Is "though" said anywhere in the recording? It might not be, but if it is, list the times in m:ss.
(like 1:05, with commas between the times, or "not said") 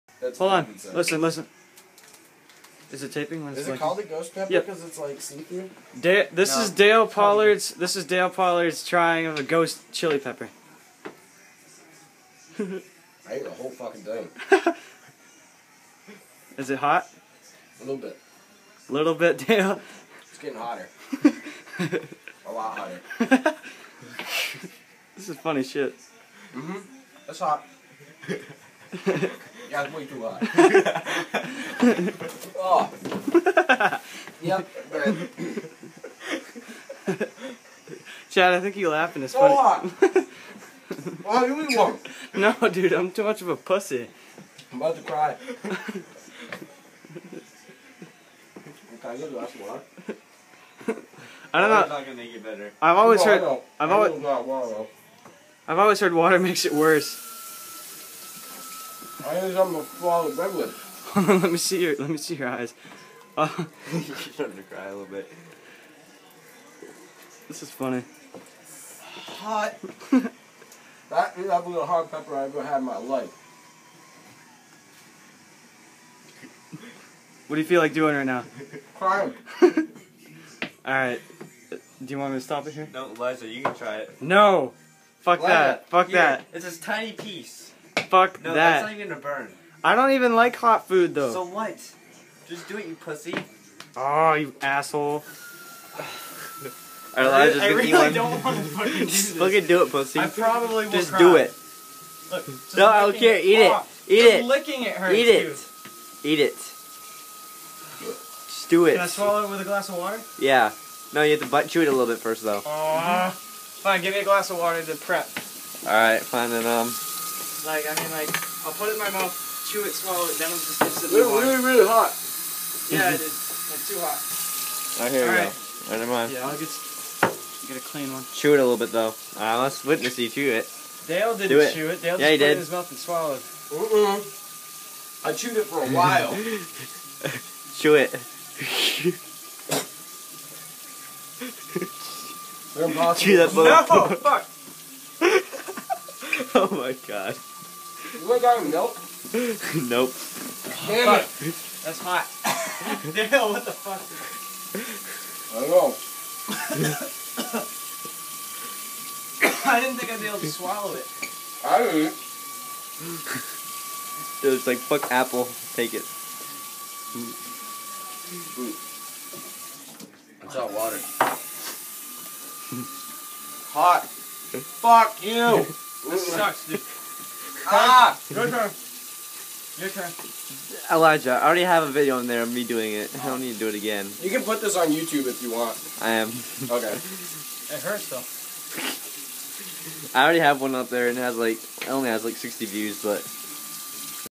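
1:31, 1:52, 2:08, 3:08.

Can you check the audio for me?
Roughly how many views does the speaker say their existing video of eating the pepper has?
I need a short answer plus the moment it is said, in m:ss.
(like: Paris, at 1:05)
60, at 3:12.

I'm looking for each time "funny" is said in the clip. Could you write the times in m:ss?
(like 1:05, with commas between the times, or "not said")
0:25, 0:39, 1:07.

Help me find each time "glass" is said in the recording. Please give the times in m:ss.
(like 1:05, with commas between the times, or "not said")
1:49, 1:54.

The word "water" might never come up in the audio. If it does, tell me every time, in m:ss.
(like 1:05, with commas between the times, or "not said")
0:56, 1:49, 1:54, 2:50.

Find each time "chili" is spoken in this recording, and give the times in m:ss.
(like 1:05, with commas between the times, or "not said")
0:09.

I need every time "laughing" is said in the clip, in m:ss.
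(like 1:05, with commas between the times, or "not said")
0:38.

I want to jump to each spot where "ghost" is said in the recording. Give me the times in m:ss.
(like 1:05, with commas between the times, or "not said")
0:04, 0:09.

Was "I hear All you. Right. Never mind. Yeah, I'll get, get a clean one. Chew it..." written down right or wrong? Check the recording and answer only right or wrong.
right.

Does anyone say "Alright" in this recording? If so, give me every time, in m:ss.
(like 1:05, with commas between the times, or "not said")
1:20, 1:55.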